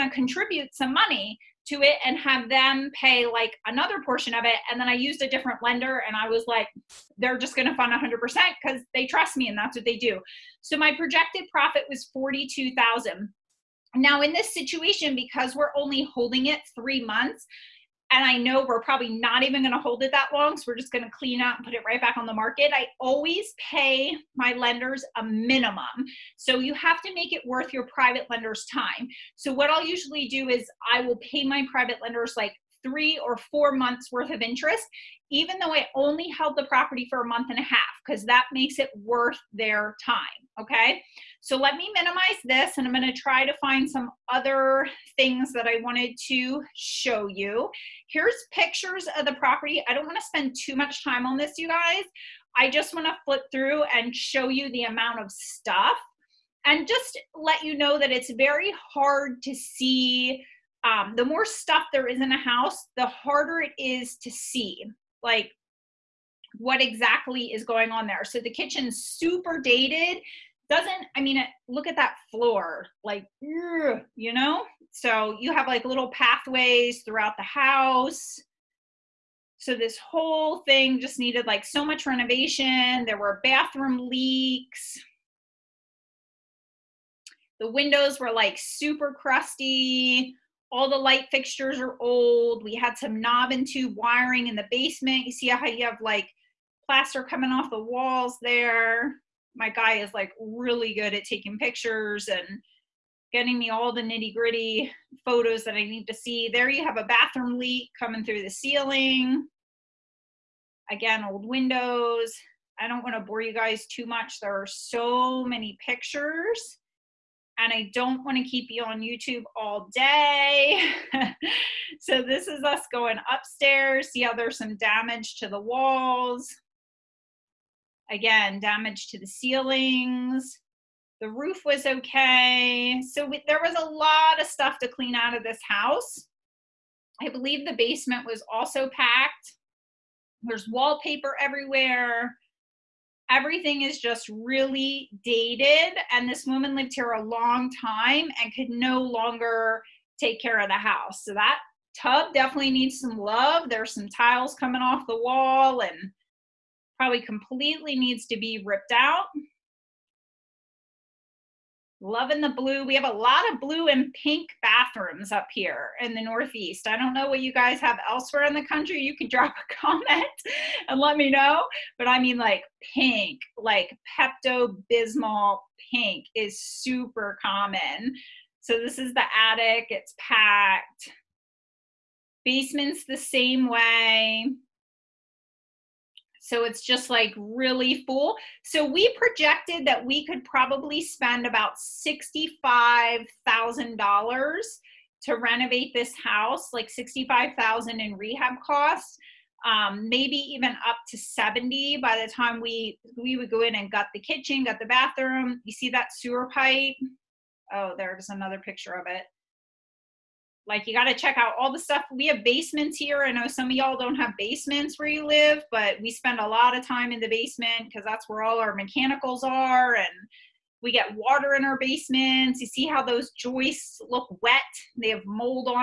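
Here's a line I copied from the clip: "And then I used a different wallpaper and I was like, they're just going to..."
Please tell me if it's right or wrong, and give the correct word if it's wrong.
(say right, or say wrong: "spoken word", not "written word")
wrong: "lender", not "wallpaper".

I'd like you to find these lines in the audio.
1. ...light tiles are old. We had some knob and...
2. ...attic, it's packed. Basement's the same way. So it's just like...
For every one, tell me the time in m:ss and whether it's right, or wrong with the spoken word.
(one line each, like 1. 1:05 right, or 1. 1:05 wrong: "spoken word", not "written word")
1. 1:30 wrong: "fixtures", not "tiles"
2. 2:59 right.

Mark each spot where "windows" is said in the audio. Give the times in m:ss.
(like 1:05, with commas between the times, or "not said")
1:27, 1:51.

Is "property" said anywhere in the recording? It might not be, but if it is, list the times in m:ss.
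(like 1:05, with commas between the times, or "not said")
0:36, 0:49.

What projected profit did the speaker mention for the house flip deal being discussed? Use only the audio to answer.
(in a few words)
$42,000.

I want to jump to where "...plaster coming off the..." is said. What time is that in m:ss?
1:36.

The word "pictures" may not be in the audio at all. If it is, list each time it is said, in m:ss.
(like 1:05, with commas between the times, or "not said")
0:48, 1:41, 1:55, 3:28.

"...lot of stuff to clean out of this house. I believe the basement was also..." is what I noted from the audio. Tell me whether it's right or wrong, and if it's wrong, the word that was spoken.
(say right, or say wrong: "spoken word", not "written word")
right.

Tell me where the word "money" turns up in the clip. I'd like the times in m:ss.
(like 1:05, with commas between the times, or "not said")
0:00.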